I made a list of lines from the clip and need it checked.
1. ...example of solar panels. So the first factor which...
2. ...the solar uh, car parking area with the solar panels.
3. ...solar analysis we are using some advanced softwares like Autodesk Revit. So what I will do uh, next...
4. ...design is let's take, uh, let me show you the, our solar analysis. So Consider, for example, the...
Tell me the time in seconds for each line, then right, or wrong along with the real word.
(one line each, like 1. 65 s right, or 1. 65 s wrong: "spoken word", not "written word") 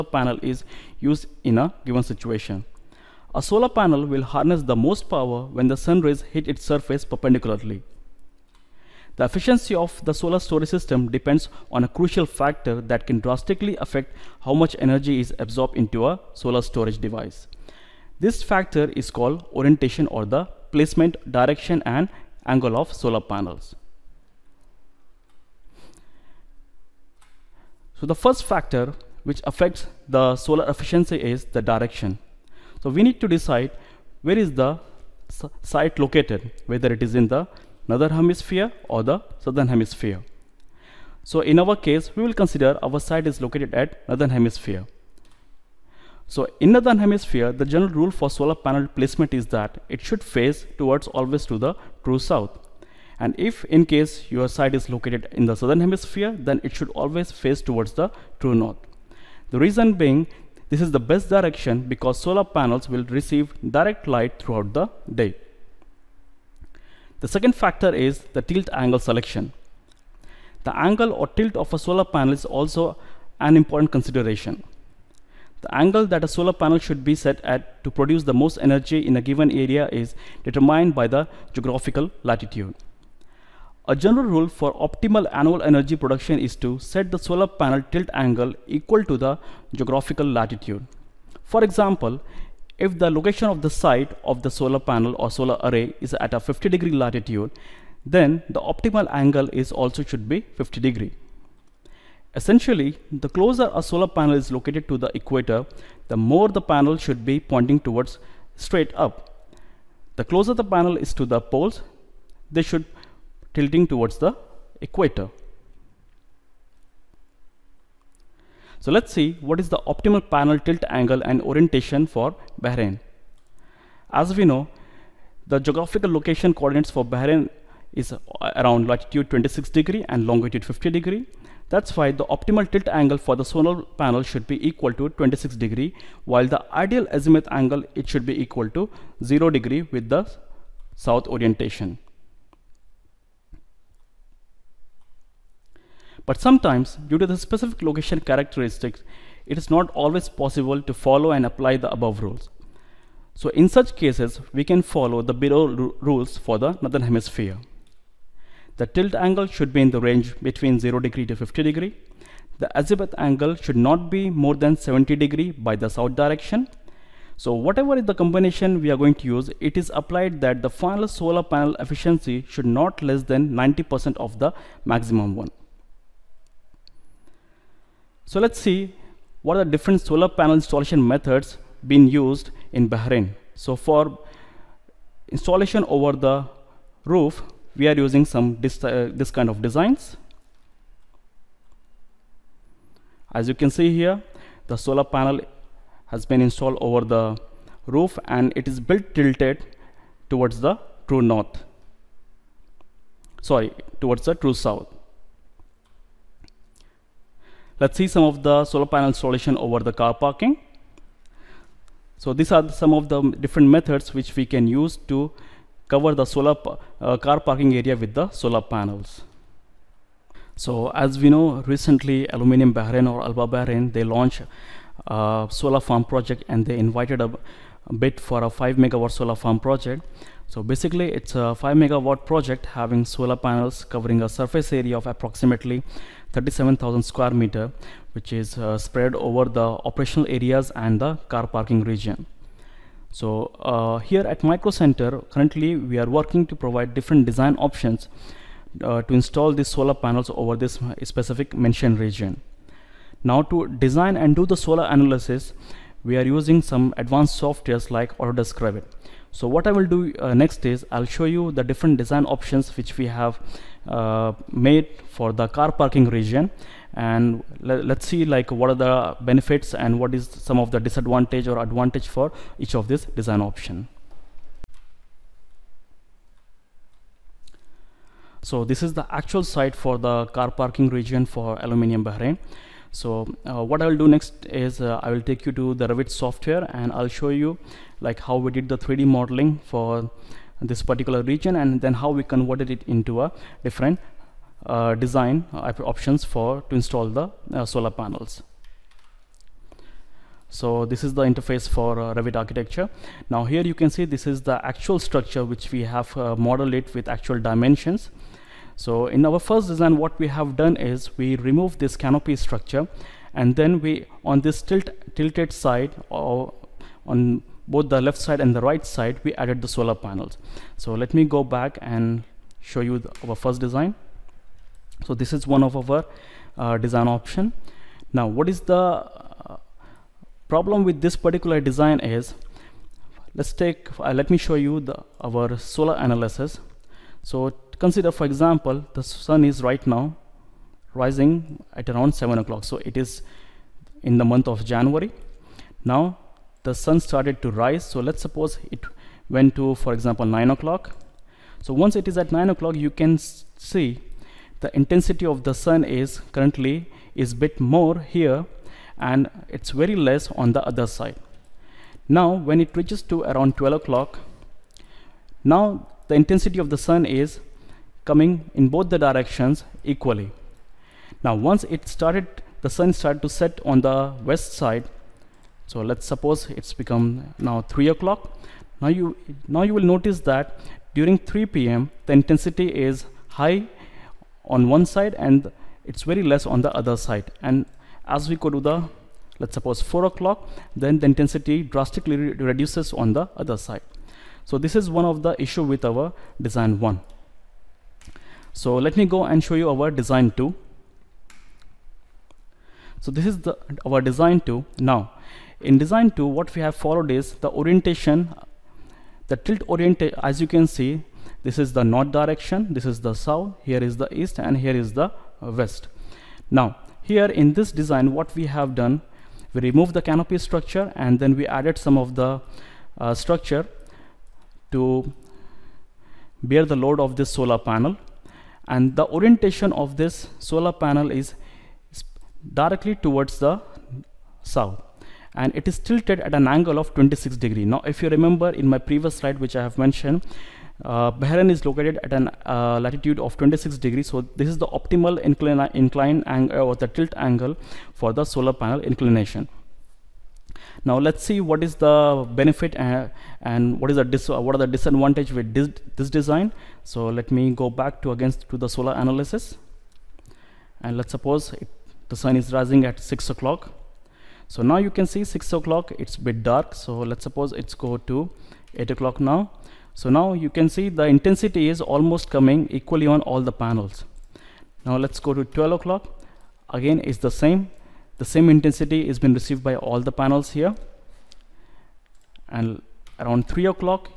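1. 22 s wrong: "angle", not "example"
2. 216 s right
3. 254 s right
4. 331 s right.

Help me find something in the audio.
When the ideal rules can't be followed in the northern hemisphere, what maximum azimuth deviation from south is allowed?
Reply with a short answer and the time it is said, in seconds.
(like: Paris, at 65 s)
70 degrees, at 164 s.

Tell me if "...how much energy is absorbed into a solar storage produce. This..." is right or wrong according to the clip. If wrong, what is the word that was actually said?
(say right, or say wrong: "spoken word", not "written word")
wrong: "device", not "produce".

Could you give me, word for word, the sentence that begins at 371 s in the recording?
Now once it started, the sun started to set on the west side.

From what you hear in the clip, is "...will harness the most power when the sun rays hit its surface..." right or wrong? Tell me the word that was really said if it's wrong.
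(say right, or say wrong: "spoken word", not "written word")
right.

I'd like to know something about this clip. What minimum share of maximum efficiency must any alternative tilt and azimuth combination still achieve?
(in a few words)
90%.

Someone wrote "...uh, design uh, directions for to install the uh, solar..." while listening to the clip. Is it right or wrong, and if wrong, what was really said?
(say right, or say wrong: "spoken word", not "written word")
wrong: "options", not "directions".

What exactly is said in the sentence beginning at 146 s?
But sometimes, due to the specific location characteristics, it is not always possible to follow and apply the above rules.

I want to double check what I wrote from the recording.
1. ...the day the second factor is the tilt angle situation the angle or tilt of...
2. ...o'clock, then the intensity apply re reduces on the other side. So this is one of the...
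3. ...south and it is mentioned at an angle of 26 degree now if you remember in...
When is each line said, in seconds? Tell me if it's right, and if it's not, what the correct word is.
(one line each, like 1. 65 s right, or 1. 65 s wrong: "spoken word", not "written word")
1. 64 s wrong: "selection", not "situation"
2. 390 s wrong: "drastically", not "apply"
3. 434 s wrong: "tilted", not "mentioned".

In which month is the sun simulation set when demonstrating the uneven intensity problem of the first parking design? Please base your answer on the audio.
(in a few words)
January.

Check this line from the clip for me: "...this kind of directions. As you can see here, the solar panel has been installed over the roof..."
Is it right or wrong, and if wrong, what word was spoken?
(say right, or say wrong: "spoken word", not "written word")
wrong: "designs", not "directions".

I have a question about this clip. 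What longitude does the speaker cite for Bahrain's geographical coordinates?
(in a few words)
50 degrees.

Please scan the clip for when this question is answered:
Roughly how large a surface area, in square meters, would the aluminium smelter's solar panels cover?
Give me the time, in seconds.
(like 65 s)
236 s.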